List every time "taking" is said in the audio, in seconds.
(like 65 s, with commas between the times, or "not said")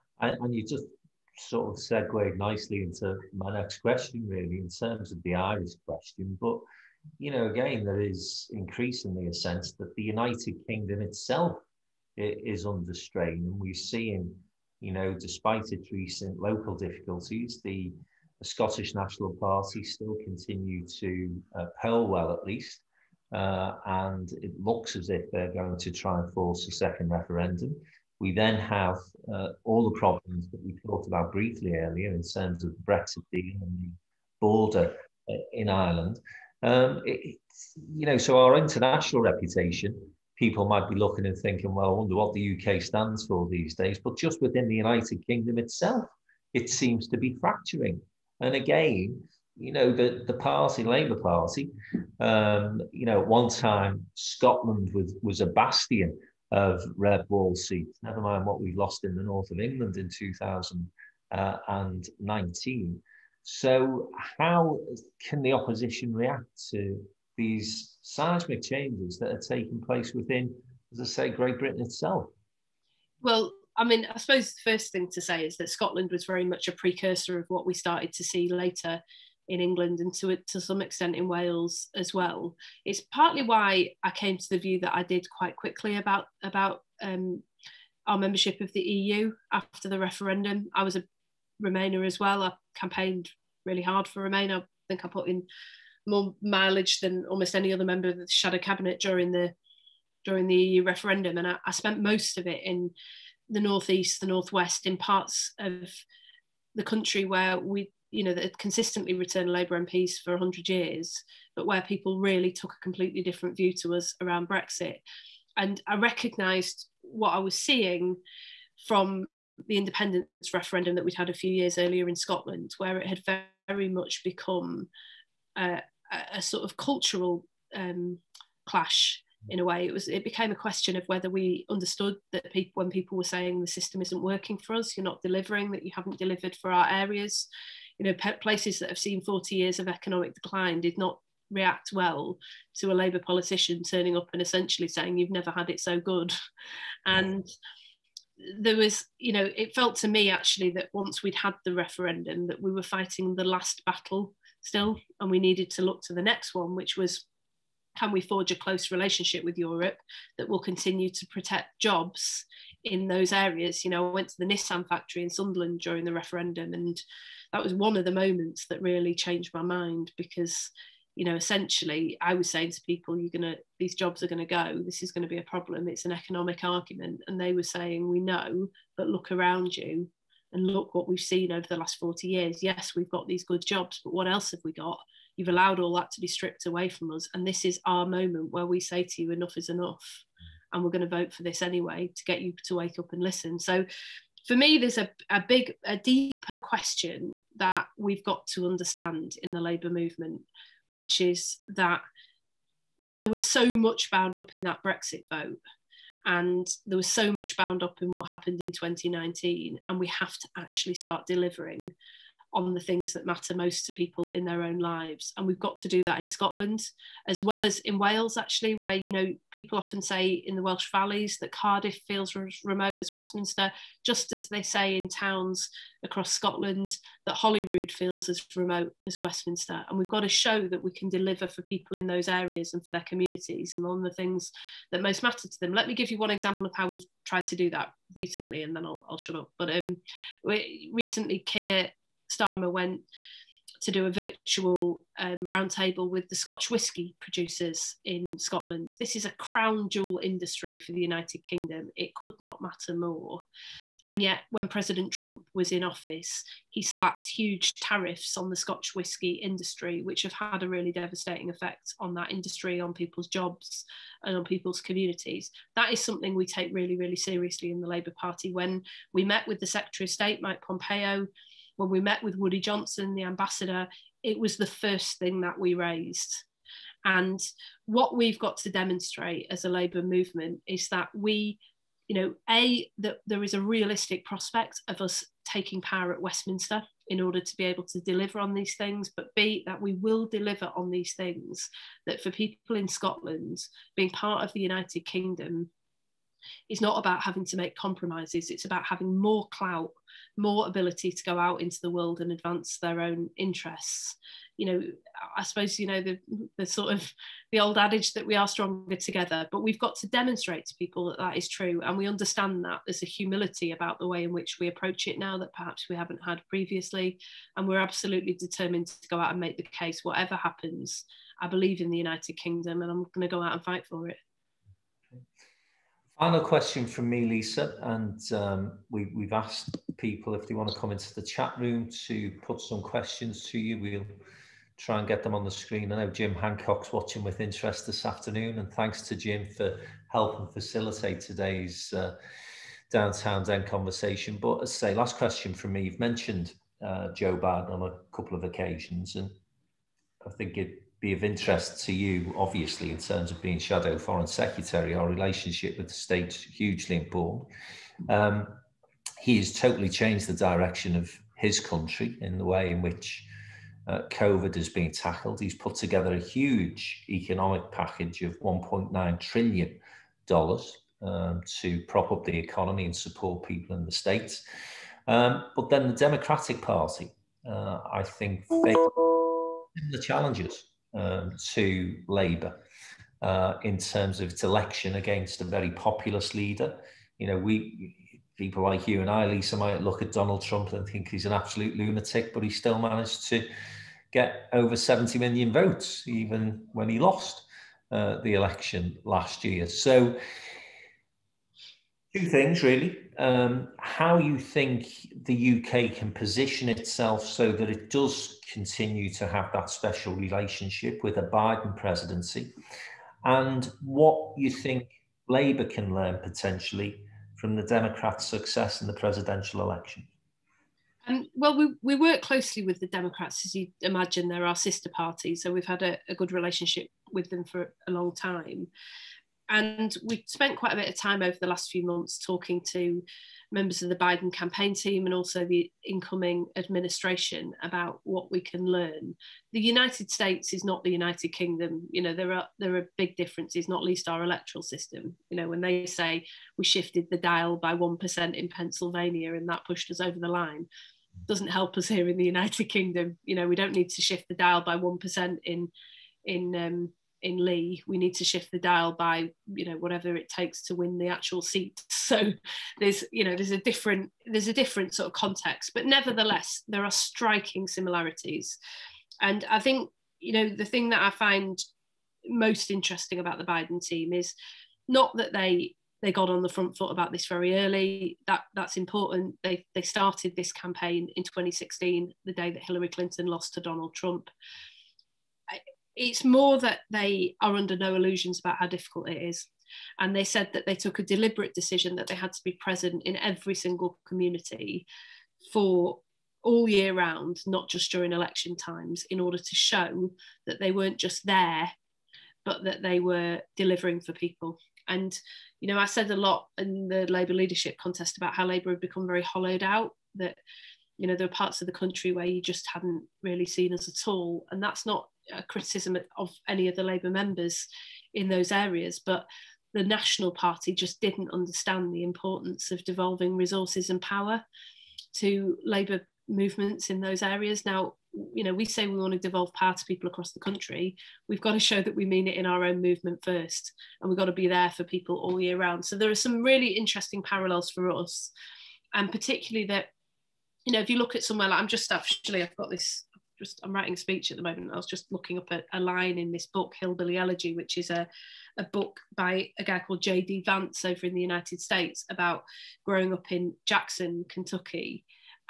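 69 s, 285 s.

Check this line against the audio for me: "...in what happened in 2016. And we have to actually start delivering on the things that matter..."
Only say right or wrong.
wrong.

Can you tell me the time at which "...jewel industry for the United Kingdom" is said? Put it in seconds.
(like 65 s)
249 s.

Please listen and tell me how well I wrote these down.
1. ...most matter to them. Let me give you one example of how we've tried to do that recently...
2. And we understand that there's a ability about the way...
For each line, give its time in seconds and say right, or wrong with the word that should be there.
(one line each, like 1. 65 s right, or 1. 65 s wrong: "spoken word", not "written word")
1. 235 s right
2. 311 s wrong: "humility", not "ability".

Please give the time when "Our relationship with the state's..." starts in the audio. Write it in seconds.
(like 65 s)
354 s.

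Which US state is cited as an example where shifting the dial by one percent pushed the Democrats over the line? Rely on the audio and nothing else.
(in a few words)
Pennsylvania.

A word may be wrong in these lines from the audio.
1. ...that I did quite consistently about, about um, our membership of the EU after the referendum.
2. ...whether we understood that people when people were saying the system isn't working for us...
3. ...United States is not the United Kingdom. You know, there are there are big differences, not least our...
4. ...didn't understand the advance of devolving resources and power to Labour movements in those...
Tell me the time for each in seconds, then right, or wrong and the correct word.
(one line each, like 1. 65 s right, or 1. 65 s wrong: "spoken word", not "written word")
1. 84 s wrong: "quickly", not "consistently"
2. 131 s right
3. 439 s right
4. 521 s wrong: "importance", not "advance".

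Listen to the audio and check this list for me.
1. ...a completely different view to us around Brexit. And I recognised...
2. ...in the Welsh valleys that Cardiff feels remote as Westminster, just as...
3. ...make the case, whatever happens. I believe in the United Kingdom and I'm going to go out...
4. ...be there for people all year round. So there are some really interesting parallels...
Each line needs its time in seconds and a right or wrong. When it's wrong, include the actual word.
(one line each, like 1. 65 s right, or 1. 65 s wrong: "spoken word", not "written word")
1. 112 s right
2. 220 s right
3. 319 s right
4. 534 s right.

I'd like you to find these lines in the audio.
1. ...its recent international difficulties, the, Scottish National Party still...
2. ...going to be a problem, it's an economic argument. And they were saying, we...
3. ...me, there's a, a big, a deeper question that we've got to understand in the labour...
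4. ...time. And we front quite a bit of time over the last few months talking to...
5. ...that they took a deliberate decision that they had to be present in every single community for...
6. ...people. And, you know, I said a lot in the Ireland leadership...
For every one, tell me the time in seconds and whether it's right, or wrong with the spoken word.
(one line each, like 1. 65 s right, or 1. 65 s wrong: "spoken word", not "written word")
1. 15 s wrong: "local", not "international"
2. 175 s right
3. 194 s right
4. 428 s wrong: "spent", not "front"
5. 490 s right
6. 504 s wrong: "Labour", not "Ireland".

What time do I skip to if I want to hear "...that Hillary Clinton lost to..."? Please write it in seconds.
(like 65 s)
482 s.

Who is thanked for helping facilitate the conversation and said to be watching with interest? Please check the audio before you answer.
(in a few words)
Jim Hancock.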